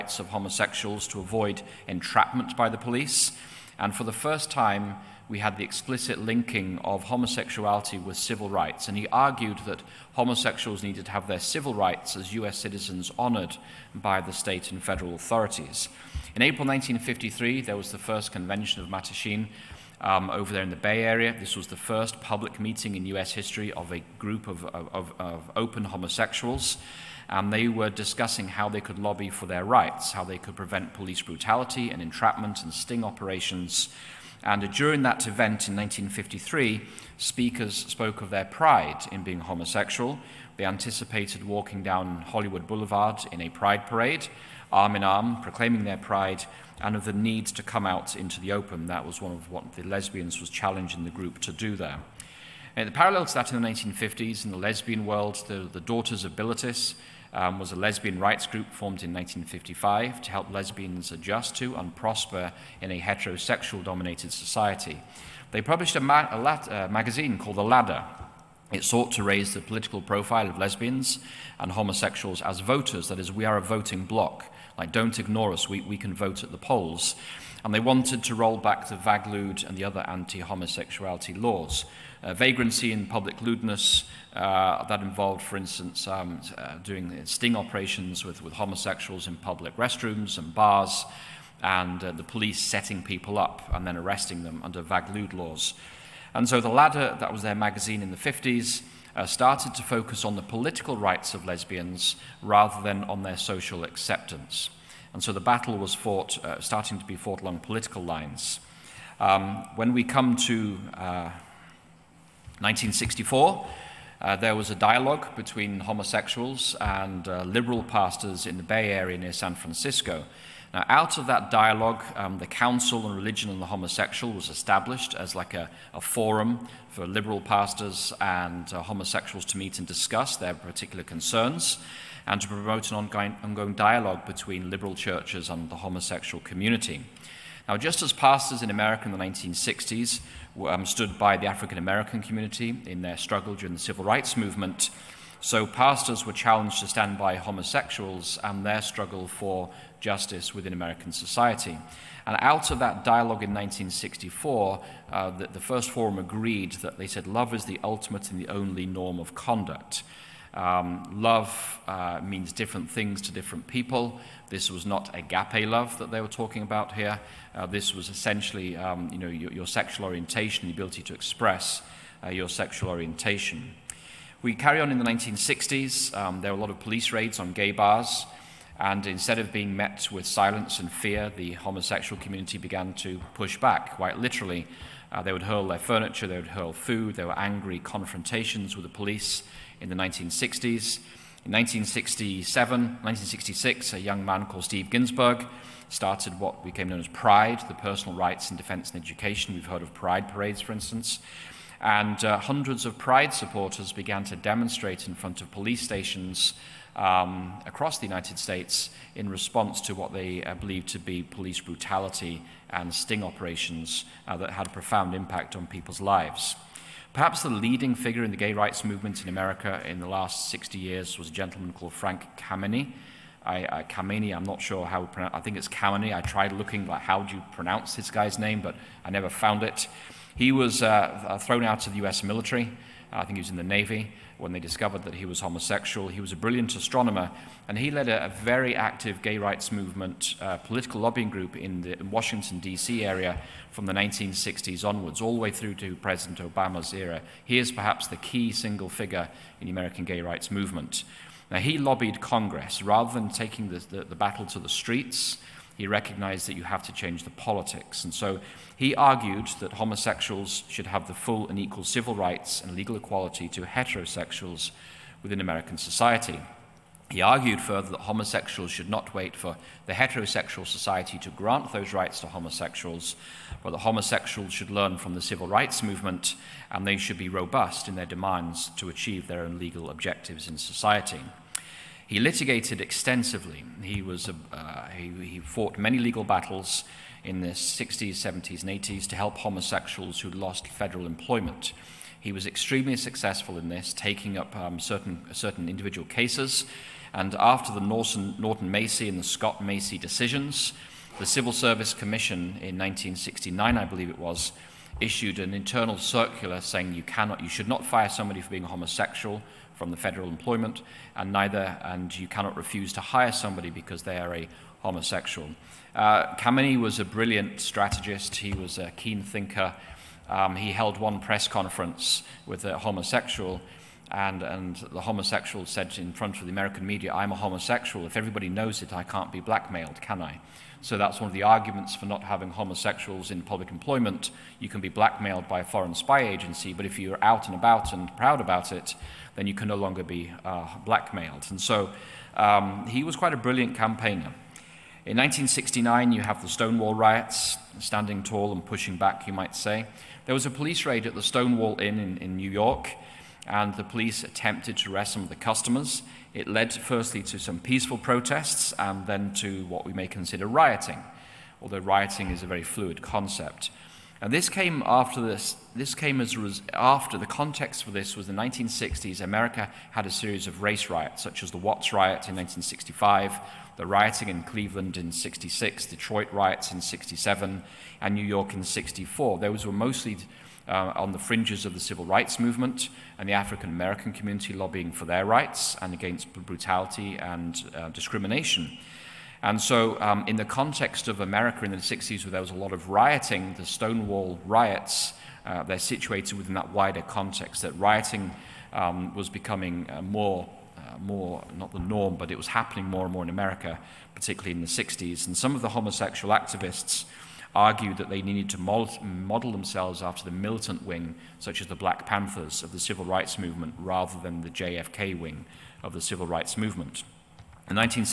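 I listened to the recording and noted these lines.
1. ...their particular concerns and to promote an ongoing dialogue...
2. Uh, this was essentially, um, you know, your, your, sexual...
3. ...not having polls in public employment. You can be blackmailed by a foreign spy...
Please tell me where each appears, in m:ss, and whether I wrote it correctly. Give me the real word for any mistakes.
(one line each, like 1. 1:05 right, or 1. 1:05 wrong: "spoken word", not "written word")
1. 2:10 right
2. 2:47 right
3. 5:32 wrong: "homosexuals", not "polls".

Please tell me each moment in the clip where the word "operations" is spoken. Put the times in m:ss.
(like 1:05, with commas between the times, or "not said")
0:33, 1:27, 3:33.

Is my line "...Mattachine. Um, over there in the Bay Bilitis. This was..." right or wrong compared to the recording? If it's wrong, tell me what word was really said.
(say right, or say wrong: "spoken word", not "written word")
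wrong: "Area", not "Bilitis".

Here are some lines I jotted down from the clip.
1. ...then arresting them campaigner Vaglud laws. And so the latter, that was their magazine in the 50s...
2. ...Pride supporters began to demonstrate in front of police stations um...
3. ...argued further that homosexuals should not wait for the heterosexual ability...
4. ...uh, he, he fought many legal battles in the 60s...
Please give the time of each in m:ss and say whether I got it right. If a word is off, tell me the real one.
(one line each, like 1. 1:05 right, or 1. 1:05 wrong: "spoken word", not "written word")
1. 1:33 wrong: "under", not "campaigner"
2. 3:22 right
3. 4:27 wrong: "society", not "ability"
4. 4:44 right.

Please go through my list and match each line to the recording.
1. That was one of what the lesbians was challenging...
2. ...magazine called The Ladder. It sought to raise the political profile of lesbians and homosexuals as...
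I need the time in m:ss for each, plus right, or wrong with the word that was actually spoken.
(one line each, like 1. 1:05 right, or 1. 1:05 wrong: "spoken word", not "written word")
1. 0:48 right
2. 1:06 right.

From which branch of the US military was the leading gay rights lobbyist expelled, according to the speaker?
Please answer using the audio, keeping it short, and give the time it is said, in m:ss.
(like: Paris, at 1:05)
Navy, at 3:53.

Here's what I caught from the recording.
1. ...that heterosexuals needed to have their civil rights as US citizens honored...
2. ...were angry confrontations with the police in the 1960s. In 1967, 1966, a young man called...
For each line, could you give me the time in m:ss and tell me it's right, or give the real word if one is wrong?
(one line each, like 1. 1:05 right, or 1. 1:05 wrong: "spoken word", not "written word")
1. 0:09 wrong: "homosexuals", not "heterosexuals"
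2. 3:07 right.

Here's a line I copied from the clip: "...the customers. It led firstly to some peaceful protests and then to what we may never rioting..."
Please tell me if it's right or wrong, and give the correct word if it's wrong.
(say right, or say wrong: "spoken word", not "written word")
wrong: "consider", not "never".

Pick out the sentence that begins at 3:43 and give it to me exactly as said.
I, uh, Kameny, I'm not sure how, I think it's Kameny.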